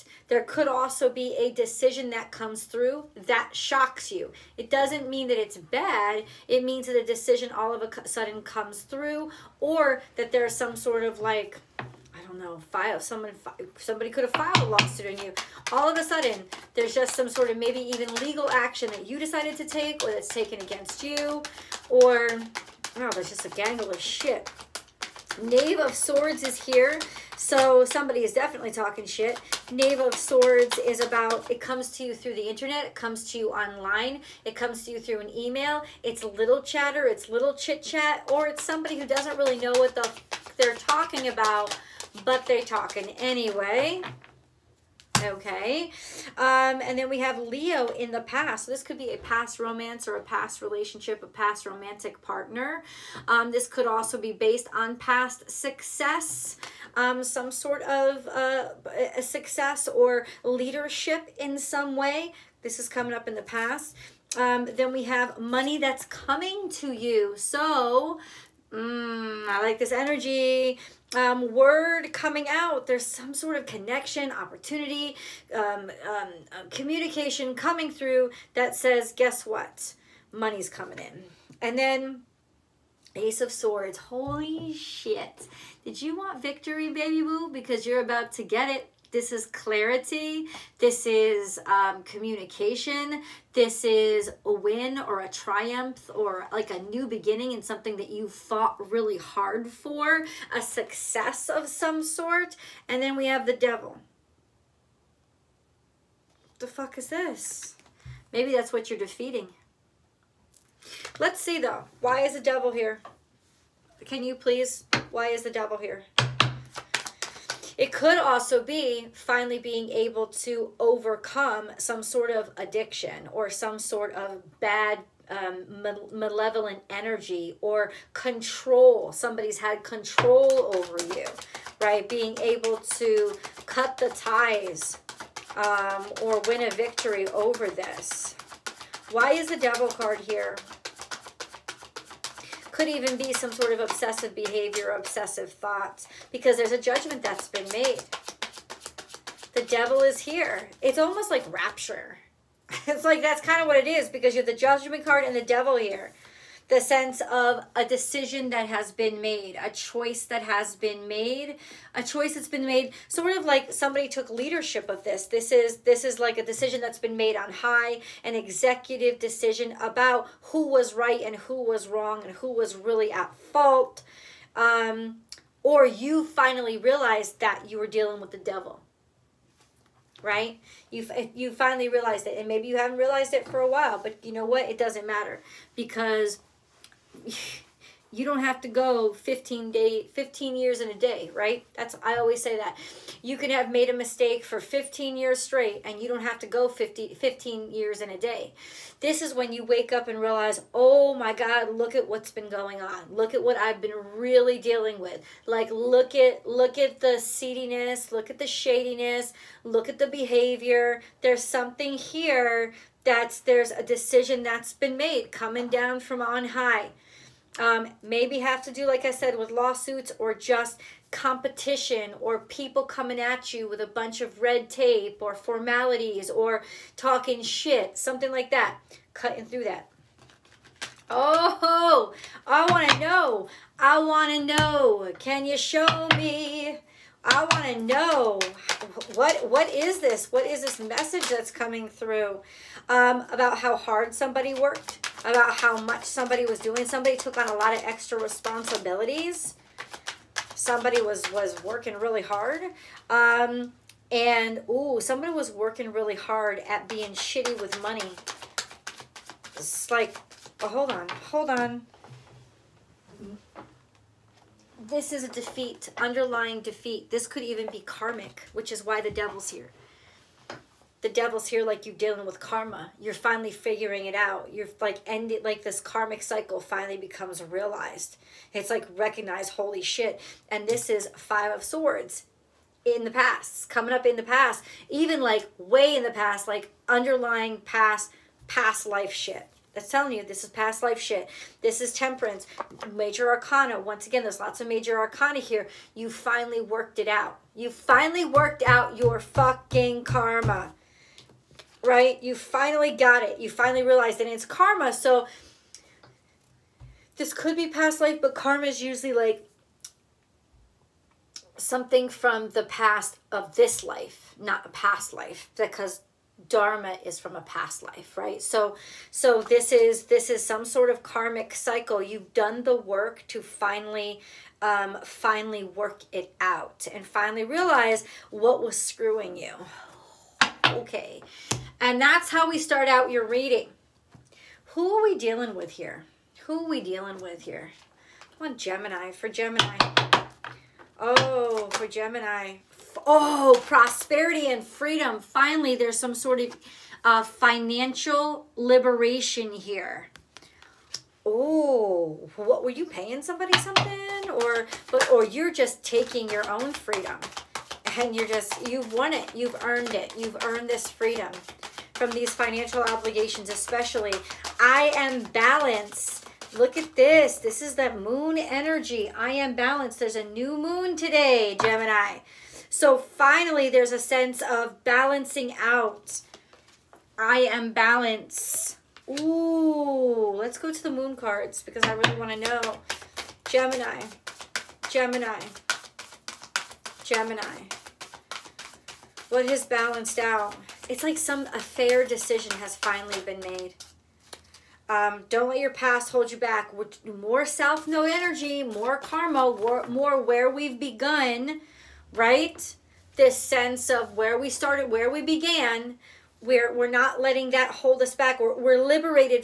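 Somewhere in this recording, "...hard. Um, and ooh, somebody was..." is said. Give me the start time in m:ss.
4:12.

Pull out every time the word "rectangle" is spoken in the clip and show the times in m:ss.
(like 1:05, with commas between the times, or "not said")
not said.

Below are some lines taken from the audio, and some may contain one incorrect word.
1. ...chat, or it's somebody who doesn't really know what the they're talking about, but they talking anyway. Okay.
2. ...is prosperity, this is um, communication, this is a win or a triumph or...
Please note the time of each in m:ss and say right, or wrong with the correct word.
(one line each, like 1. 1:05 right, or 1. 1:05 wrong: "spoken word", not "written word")
1. 0:37 right
2. 1:29 wrong: "clarity", not "prosperity".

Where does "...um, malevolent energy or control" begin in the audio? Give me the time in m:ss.
2:05.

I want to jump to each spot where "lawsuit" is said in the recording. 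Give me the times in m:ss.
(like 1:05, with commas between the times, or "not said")
0:14, 3:39.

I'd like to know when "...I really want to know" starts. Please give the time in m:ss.
6:21.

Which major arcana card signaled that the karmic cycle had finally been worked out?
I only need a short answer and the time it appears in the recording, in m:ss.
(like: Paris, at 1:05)
Temperance, at 4:51.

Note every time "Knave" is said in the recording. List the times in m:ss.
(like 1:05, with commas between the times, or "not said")
0:25, 0:29.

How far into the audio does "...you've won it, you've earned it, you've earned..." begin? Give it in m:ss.
5:58.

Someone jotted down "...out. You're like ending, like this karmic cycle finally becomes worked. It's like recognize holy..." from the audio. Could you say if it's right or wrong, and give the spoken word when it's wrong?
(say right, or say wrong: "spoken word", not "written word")
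wrong: "realized", not "worked".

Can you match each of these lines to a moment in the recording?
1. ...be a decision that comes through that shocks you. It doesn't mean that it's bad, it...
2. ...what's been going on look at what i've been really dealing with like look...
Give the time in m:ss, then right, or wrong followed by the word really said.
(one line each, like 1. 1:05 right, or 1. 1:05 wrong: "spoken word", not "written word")
1. 0:01 right
2. 3:22 right.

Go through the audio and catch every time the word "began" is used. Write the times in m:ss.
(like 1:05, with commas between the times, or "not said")
6:45.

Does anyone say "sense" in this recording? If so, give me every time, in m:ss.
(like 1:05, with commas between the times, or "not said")
2:36, 6:13, 6:43.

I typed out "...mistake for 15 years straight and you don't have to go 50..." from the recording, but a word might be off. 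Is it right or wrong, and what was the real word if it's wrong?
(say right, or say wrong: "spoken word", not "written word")
right.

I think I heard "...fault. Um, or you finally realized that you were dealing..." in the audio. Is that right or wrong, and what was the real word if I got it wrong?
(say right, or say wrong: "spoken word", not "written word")
right.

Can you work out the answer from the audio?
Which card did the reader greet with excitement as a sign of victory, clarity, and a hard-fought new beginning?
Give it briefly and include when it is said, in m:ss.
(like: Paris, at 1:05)
Ace of Swords, at 1:23.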